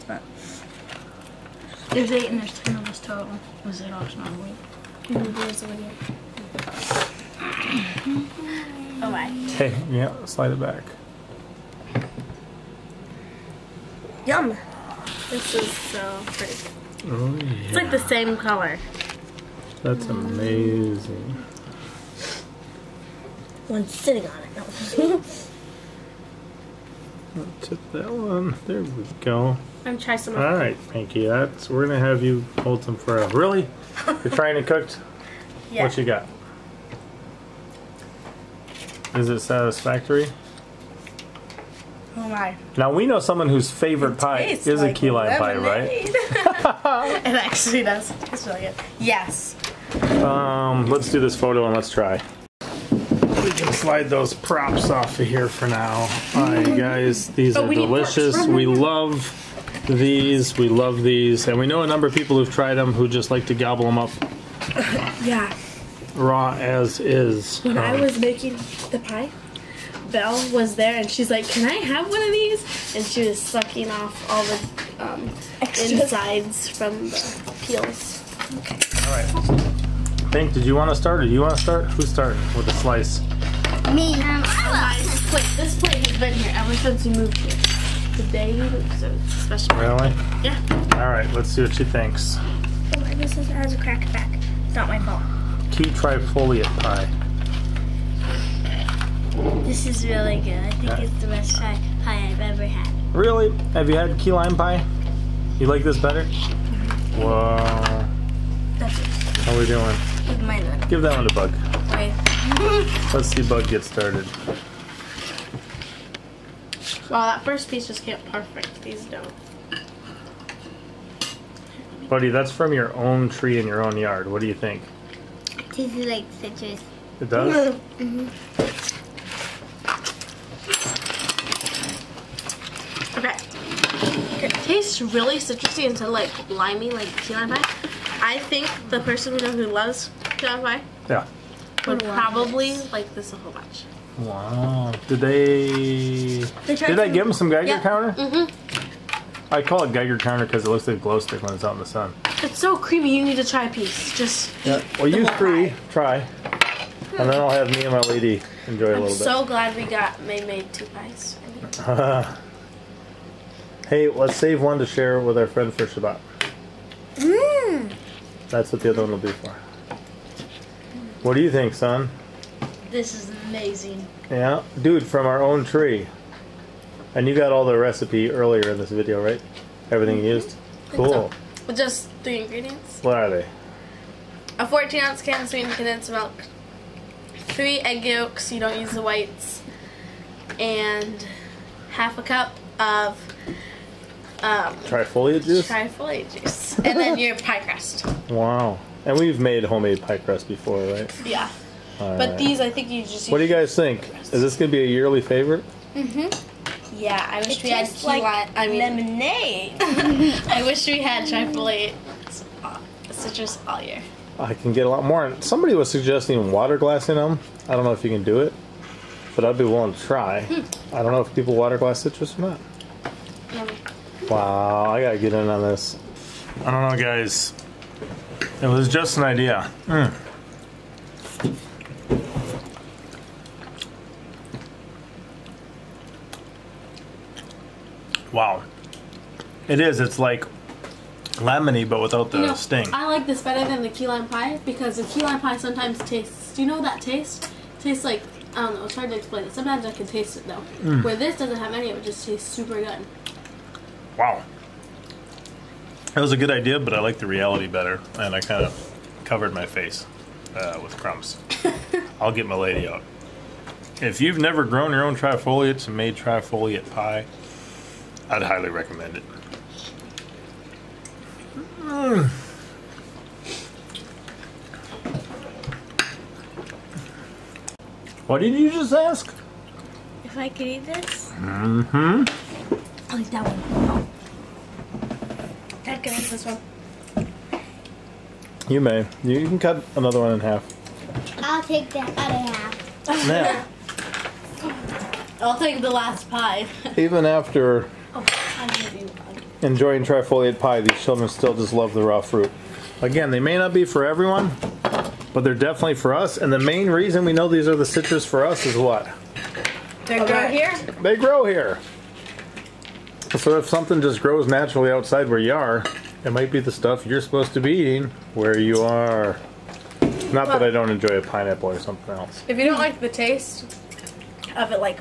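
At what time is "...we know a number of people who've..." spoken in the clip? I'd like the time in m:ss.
1:01.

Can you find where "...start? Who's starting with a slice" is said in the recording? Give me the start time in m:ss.
1:21.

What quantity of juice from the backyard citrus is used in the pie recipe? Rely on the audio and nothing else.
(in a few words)
half a cup.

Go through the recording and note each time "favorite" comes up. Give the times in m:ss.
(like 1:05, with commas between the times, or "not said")
0:43, 3:25.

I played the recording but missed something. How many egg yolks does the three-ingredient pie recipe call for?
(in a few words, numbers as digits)
3.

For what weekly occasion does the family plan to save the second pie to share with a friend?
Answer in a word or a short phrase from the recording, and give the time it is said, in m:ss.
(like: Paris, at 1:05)
Shabbat, at 2:45.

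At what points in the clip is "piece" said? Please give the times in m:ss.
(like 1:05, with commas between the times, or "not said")
1:57, 2:33.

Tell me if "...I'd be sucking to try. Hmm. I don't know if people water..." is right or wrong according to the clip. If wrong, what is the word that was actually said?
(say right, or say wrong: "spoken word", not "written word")
wrong: "willing", not "sucking".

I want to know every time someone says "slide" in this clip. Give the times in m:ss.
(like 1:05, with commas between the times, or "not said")
0:10, 0:53.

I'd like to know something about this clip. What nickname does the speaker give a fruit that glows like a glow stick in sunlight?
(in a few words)
Geiger counter.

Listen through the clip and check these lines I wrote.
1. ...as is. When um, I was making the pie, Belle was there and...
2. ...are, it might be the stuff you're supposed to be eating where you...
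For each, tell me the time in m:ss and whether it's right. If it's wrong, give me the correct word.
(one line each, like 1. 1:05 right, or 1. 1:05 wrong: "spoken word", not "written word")
1. 1:06 right
2. 5:15 right.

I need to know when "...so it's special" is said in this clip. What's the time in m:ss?
1:28.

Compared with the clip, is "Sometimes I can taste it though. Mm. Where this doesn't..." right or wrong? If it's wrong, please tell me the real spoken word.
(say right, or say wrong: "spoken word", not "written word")
right.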